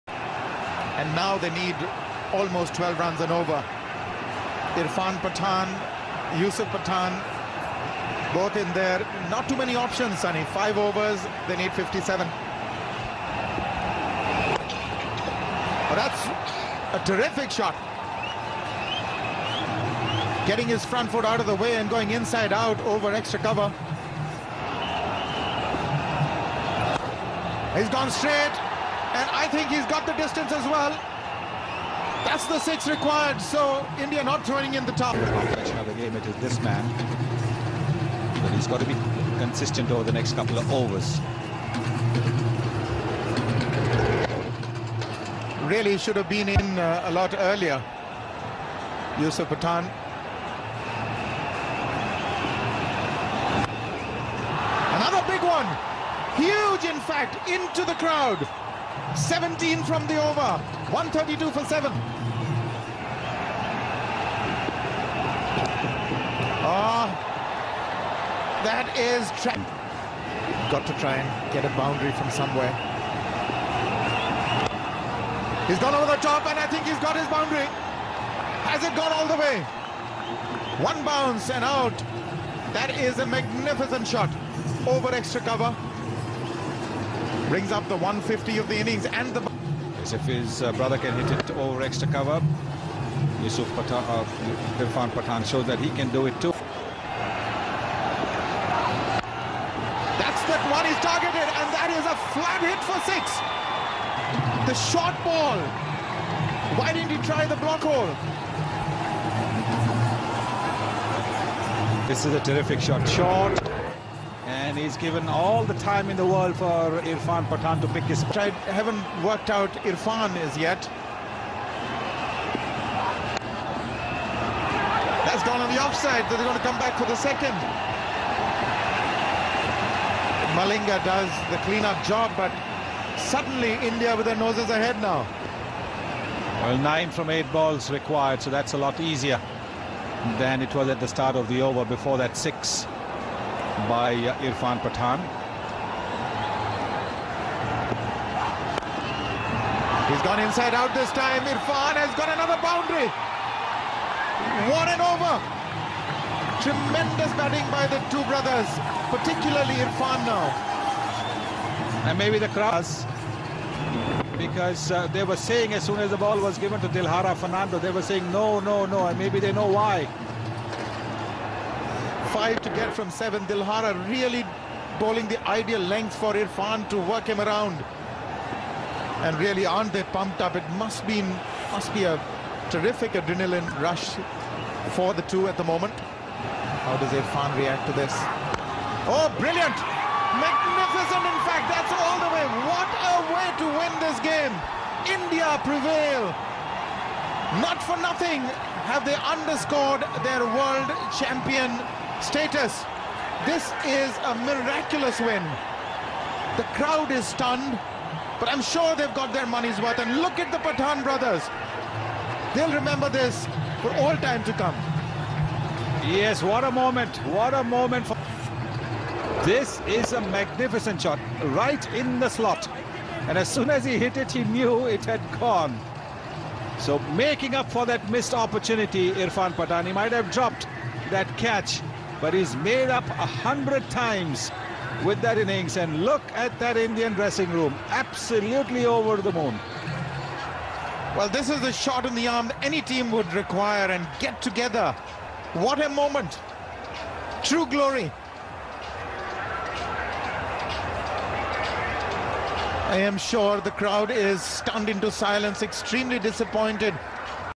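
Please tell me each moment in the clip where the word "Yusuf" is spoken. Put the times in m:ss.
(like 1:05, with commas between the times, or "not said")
0:06, 0:49, 1:33.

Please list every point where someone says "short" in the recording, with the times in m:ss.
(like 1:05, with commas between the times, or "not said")
1:44, 1:53.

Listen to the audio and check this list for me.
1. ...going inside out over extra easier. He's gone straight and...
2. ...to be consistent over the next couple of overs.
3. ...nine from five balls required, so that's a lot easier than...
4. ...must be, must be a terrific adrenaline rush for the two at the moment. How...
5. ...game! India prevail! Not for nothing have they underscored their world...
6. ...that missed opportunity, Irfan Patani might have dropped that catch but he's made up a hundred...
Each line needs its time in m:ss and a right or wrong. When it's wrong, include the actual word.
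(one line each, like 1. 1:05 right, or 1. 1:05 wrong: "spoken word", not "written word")
1. 0:21 wrong: "cover", not "easier"
2. 0:38 right
3. 2:16 wrong: "eight", not "five"
4. 3:00 right
5. 3:14 right
6. 3:47 right.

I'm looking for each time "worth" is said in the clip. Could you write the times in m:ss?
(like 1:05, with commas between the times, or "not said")
3:29.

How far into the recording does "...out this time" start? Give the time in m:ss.
2:30.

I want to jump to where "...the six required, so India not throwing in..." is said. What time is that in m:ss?
0:32.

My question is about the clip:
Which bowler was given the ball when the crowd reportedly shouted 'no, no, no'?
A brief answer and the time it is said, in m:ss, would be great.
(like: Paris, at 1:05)
Dilhara Fernando, at 2:46.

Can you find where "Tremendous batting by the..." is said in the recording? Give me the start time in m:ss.
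2:36.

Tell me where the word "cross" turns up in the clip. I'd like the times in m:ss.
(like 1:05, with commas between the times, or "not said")
2:42.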